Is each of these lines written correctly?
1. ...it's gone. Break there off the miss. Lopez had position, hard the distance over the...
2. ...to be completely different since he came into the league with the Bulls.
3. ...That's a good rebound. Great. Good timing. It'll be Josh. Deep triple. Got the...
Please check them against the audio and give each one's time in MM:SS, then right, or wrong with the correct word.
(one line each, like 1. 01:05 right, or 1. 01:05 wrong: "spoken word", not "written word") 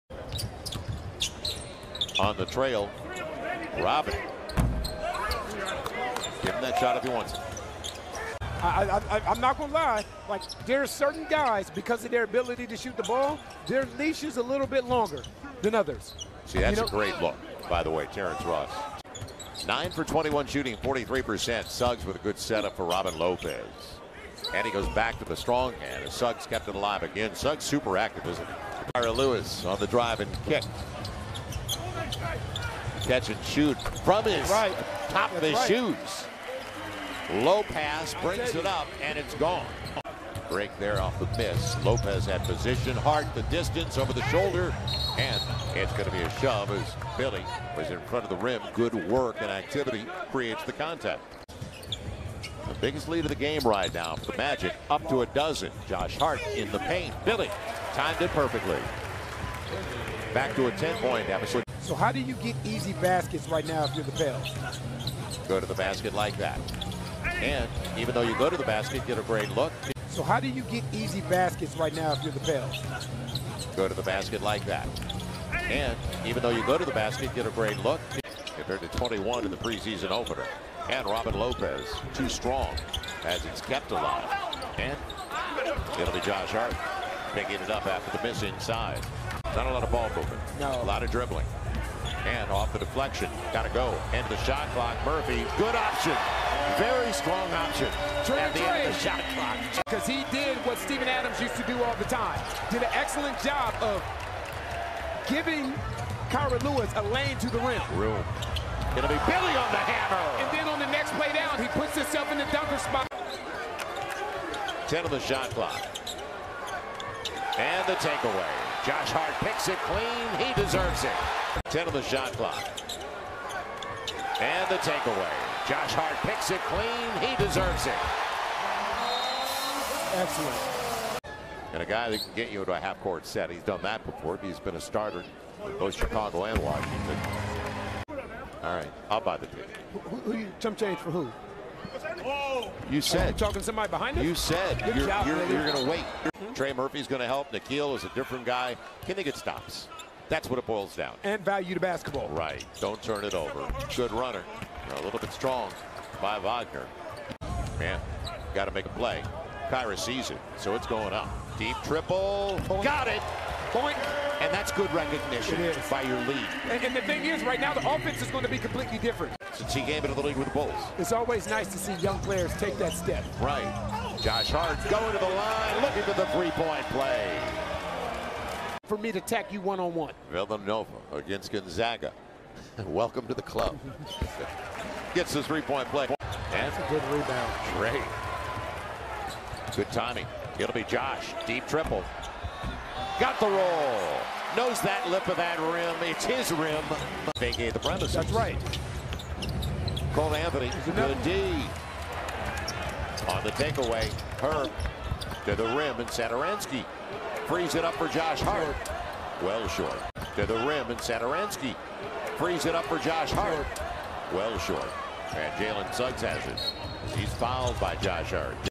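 1. 00:39 right
2. 02:48 right
3. 03:06 right.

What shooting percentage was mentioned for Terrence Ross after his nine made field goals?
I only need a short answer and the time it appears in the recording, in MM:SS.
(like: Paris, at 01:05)
43%, at 00:20.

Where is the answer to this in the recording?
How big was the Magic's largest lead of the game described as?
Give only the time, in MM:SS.
00:55.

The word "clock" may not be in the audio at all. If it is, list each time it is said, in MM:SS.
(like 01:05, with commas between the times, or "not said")
01:34, 01:39, 01:55, 02:02.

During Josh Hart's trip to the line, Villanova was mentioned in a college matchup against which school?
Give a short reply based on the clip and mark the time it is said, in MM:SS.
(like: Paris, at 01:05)
Gonzaga, at 03:01.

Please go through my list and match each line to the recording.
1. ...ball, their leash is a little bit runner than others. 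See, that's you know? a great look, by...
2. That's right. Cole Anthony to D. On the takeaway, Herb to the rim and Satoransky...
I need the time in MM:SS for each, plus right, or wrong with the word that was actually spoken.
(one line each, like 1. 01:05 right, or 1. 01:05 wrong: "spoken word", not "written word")
1. 00:13 wrong: "longer", not "runner"
2. 03:18 right.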